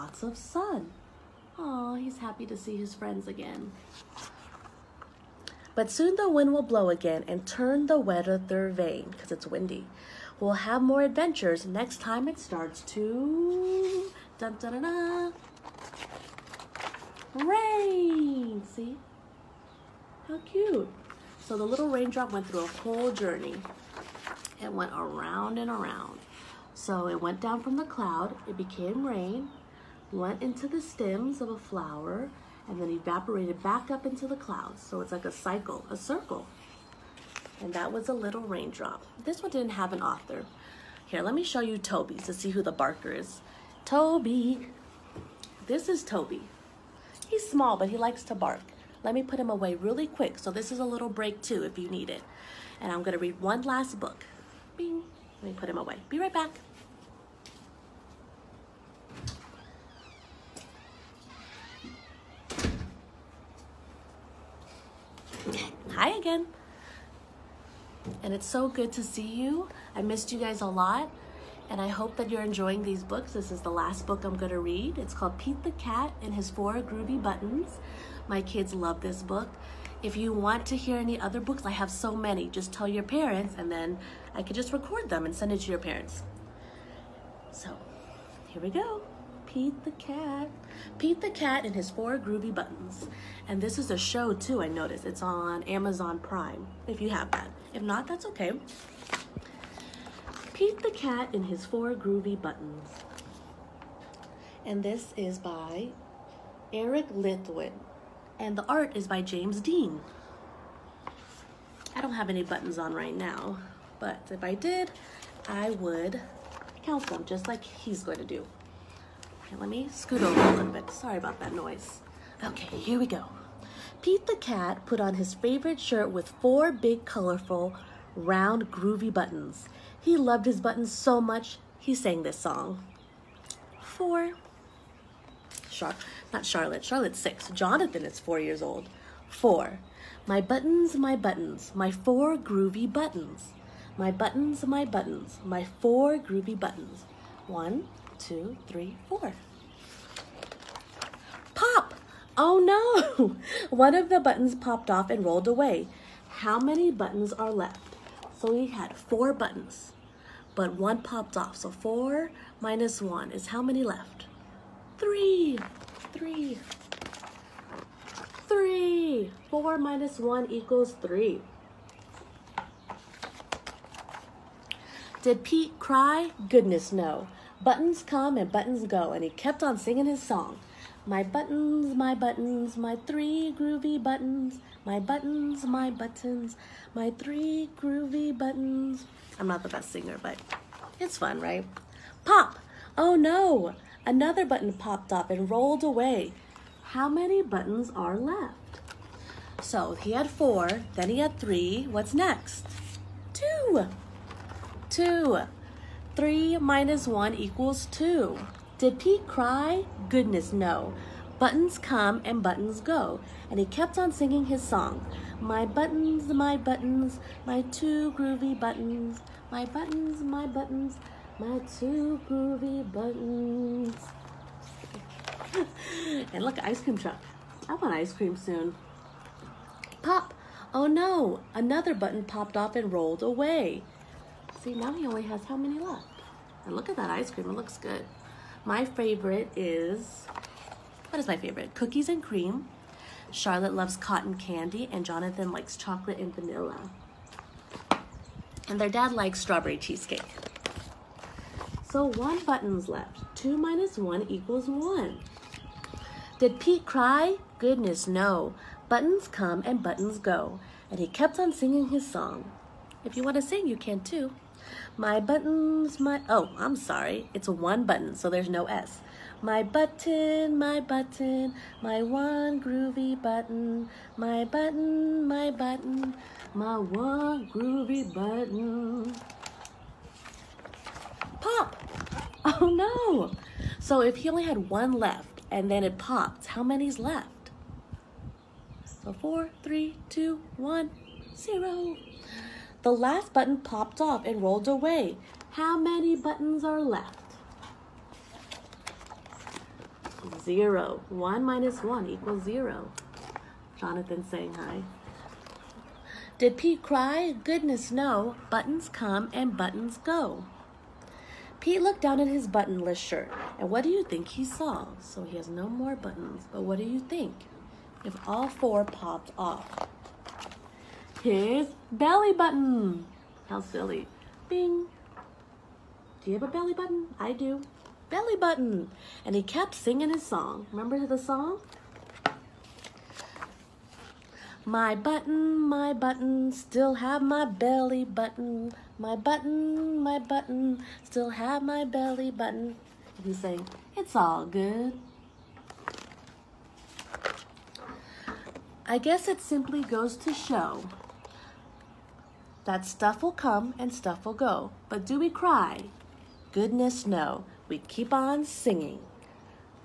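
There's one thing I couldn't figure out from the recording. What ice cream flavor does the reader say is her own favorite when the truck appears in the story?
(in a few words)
Cookies and cream.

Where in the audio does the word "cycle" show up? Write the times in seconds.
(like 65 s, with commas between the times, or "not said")
35 s.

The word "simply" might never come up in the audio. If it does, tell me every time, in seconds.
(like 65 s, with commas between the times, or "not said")
349 s.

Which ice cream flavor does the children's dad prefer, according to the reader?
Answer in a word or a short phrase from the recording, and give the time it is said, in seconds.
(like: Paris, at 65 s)
Strawberry cheesecake, at 249 s.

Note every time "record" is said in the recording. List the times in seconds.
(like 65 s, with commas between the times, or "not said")
84 s.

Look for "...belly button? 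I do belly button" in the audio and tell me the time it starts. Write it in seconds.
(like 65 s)
326 s.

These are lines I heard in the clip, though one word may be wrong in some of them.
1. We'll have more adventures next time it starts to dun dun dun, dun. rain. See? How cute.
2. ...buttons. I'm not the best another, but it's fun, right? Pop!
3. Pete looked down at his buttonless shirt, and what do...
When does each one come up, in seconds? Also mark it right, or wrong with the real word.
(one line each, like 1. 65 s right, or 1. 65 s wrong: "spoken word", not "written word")
1. 10 s right
2. 188 s wrong: "singer", not "another"
3. 311 s right.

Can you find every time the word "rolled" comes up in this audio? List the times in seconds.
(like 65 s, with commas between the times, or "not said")
155 s, 195 s, 232 s, 294 s.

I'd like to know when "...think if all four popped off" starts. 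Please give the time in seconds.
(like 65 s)
316 s.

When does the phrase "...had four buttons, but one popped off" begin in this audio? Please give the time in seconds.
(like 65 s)
158 s.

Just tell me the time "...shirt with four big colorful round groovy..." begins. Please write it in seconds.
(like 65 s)
125 s.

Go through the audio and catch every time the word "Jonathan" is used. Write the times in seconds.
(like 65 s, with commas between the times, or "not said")
137 s, 245 s, 303 s.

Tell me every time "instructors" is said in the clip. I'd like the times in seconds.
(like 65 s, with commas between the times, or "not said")
not said.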